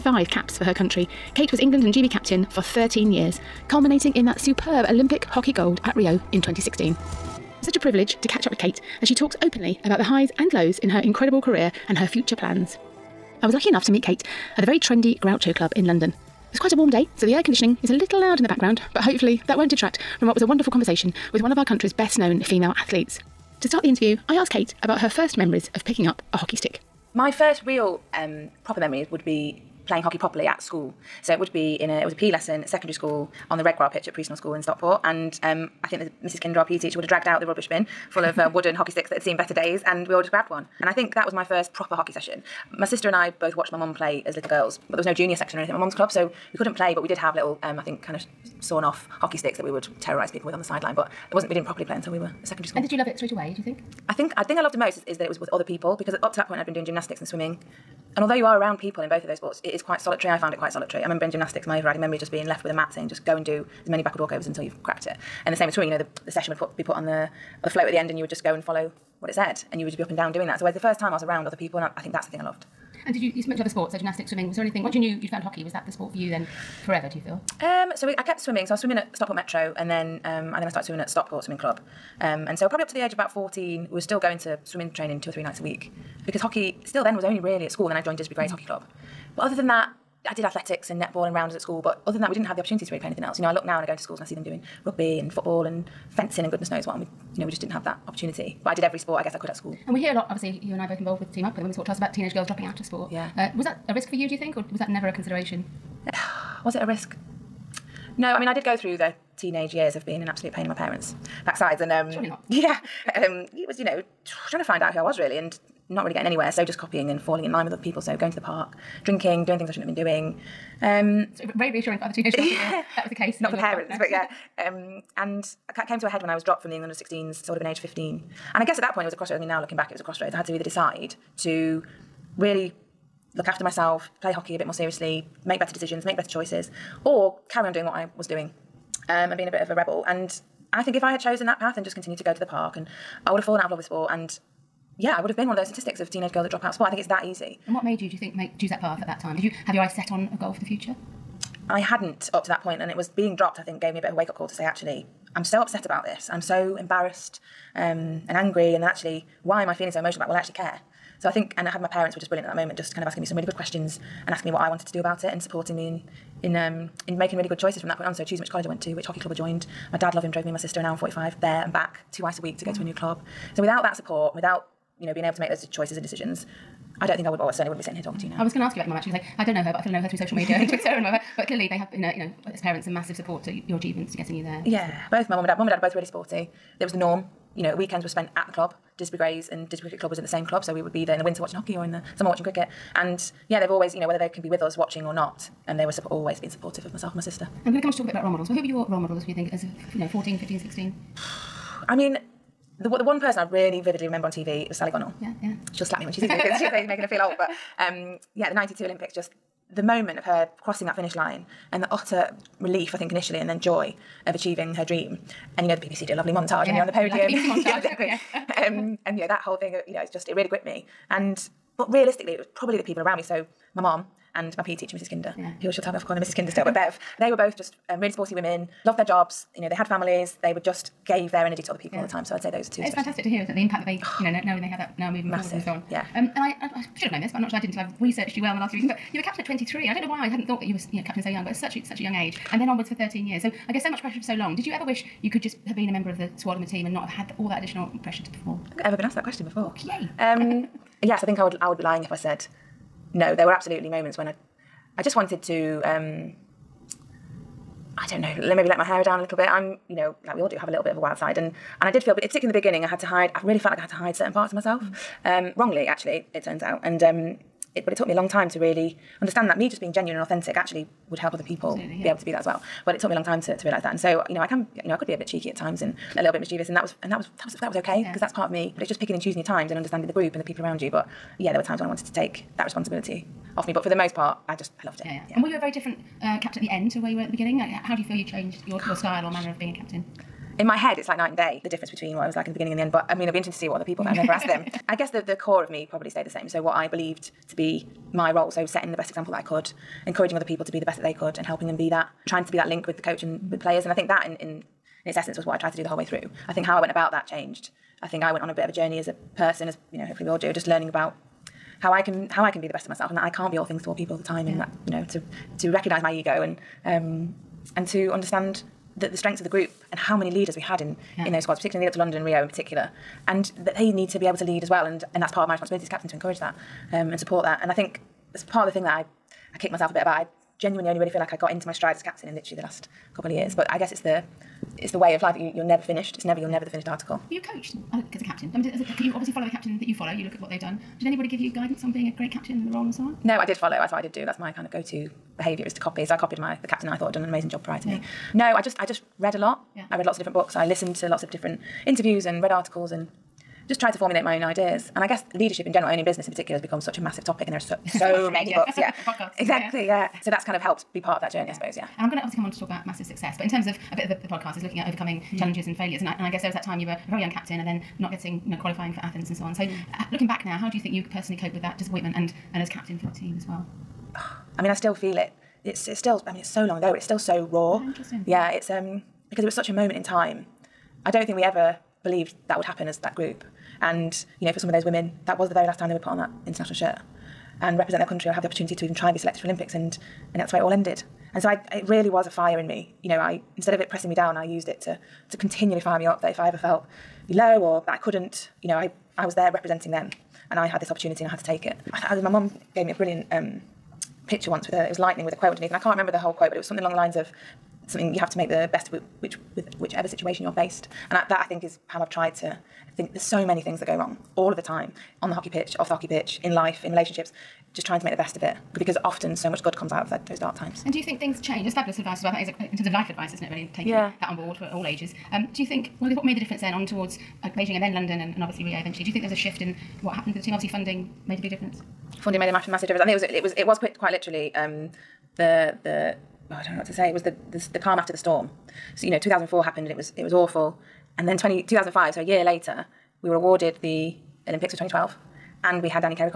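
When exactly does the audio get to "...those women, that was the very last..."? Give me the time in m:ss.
6:24.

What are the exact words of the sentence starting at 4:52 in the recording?
But I mean, it'll be interesting to see what other people that I never asked them.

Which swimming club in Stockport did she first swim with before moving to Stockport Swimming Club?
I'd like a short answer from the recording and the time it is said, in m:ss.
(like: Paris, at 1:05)
Stockport Metro, at 1:19.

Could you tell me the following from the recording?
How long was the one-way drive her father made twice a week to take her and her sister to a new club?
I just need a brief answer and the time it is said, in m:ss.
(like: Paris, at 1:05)
an hour and 45, at 2:50.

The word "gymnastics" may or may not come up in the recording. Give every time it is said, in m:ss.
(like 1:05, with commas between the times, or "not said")
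0:56, 1:01, 1:13.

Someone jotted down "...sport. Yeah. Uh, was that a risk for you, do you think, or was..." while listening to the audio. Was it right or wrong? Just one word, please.
right.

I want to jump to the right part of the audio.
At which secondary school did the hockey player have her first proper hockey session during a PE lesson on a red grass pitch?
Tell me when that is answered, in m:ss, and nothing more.
0:34.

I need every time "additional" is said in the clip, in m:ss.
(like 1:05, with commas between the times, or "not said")
4:07.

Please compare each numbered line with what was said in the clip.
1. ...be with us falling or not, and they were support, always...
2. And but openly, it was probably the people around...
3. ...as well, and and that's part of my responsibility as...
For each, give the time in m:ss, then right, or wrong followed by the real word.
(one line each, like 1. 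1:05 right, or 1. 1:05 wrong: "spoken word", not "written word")
1. 3:14 wrong: "watching", not "falling"
2. 3:41 wrong: "realistically", not "openly"
3. 5:24 right.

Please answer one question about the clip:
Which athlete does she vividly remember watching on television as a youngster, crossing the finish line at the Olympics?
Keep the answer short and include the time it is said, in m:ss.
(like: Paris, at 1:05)
Sally Gunnell, at 3:24.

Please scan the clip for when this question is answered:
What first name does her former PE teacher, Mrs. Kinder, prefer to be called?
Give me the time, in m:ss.
3:46.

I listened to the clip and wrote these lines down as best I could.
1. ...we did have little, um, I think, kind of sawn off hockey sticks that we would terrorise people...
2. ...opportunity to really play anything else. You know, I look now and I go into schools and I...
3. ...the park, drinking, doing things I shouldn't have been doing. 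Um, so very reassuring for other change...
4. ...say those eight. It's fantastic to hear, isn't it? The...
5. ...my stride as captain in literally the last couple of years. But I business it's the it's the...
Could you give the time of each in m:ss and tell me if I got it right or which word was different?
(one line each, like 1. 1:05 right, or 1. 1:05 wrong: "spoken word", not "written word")
1. 0:47 right
2. 1:32 right
3. 1:58 wrong: "teenage", not "change"
4. 3:52 wrong: "two", not "eight"
5. 5:31 wrong: "guess", not "business".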